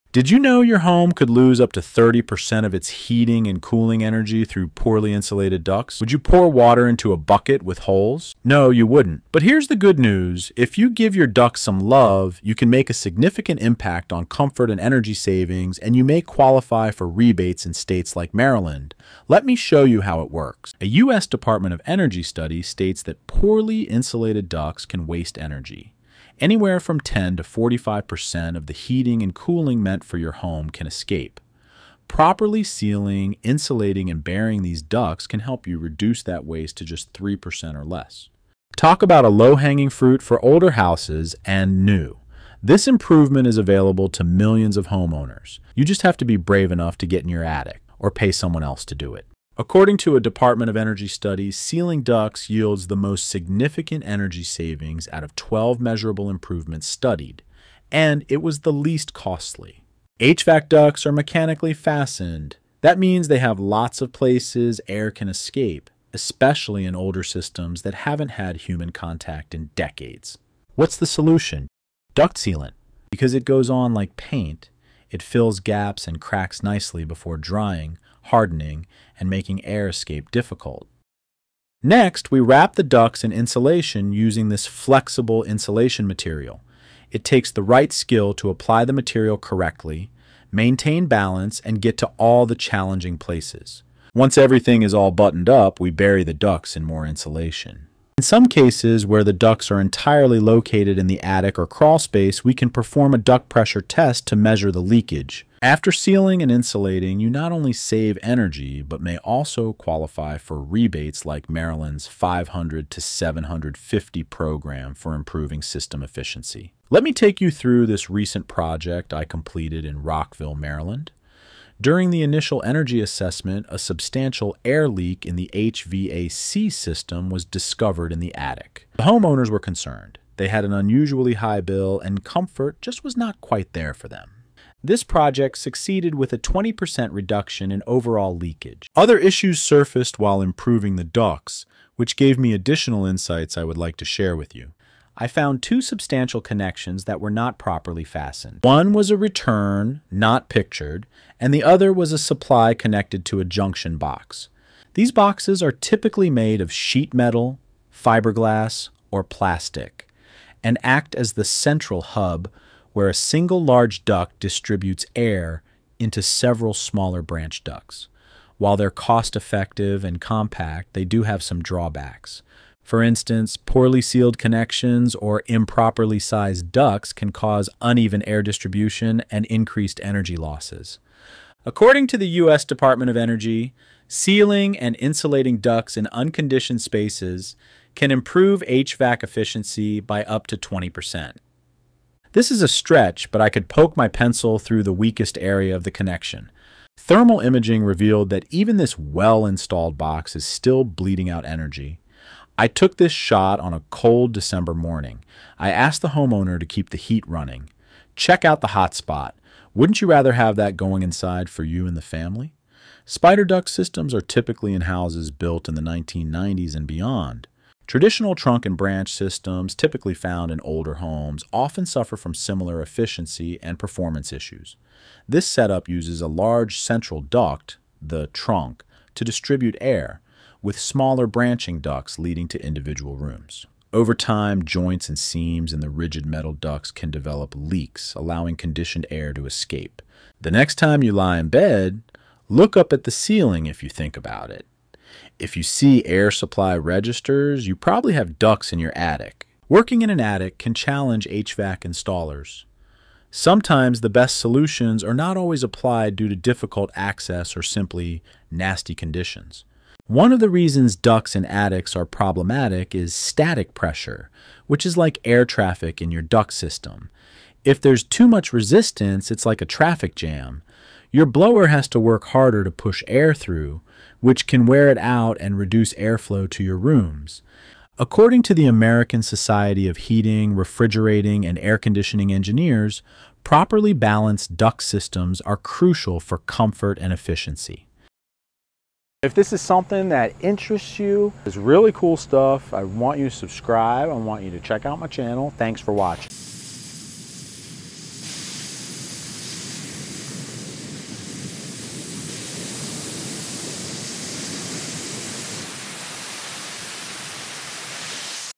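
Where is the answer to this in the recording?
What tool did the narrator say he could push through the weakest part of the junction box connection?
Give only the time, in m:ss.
3:14.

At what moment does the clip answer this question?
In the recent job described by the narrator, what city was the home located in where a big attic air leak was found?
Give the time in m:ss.
2:00.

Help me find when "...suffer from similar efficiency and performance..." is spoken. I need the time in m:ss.
3:41.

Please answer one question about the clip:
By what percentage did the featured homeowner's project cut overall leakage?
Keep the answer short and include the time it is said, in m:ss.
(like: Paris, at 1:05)
20%, at 2:16.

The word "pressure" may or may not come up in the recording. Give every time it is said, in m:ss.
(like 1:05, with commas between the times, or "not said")
1:43, 4:23.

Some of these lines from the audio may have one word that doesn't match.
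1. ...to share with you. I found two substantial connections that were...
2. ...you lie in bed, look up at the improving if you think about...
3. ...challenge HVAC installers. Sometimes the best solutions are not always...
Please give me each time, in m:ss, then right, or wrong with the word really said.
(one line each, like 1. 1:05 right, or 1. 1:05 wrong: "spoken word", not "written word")
1. 2:23 right
2. 4:01 wrong: "ceiling", not "improving"
3. 4:10 right.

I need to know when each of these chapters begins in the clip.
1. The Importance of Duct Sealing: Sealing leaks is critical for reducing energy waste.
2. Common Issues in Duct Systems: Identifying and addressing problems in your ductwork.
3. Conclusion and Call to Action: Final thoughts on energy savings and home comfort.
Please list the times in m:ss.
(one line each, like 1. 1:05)
1. 0:20
2. 2:25
3. 4:49.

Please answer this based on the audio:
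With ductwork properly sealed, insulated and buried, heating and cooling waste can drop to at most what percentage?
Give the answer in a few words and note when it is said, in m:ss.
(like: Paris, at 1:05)
3%, at 0:37.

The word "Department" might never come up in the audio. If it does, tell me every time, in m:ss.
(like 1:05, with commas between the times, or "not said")
0:21, 0:50, 3:02.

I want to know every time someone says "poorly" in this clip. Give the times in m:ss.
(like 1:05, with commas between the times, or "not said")
0:04, 0:23, 2:53.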